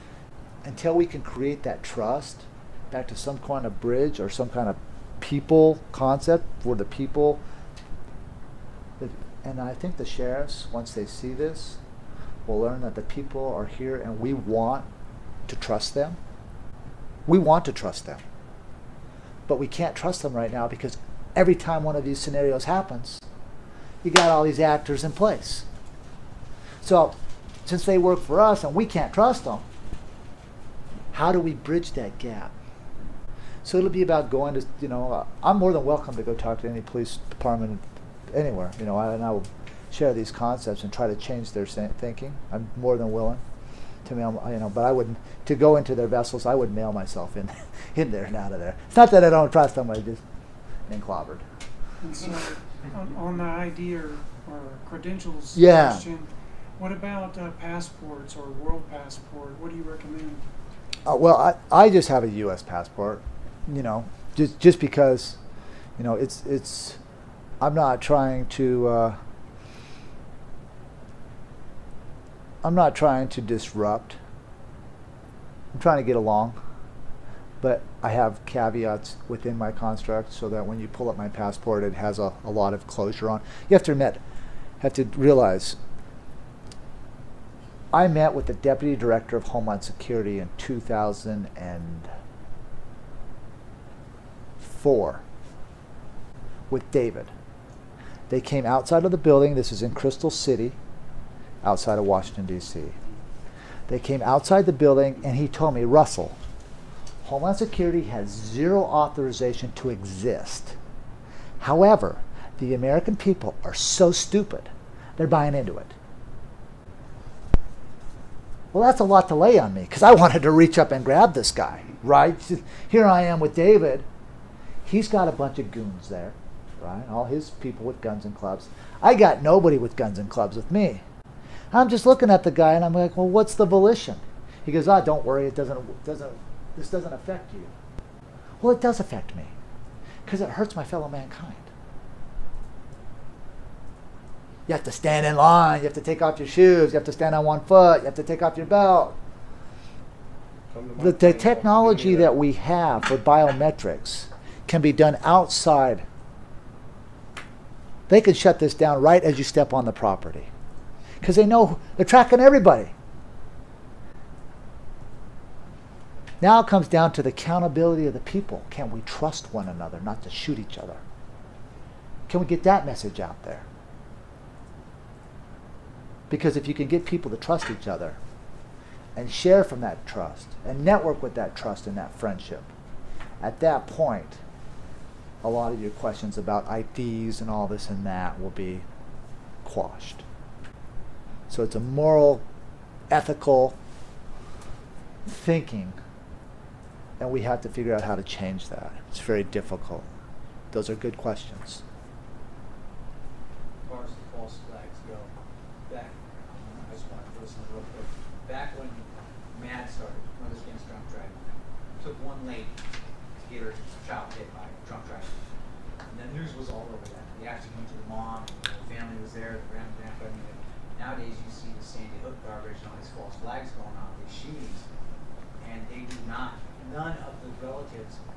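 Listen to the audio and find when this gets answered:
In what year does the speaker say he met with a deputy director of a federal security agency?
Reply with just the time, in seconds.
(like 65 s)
90 s.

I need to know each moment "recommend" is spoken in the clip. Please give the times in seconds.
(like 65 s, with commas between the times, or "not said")
59 s.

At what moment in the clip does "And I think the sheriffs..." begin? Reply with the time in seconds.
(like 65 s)
9 s.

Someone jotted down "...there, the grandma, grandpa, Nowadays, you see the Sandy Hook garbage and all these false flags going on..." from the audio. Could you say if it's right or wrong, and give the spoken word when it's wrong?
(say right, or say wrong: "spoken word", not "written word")
right.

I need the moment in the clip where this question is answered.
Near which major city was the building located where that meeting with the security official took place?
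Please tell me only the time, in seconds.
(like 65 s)
99 s.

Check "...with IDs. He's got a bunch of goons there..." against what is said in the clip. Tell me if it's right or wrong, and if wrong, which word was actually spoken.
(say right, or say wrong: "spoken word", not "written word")
wrong: "David", not "IDs".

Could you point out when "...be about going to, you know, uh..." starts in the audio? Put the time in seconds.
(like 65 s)
33 s.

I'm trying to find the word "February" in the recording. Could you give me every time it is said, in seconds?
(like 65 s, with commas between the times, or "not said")
not said.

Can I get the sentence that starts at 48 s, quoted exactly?
It's not that I don't trust them, I just been clobbered.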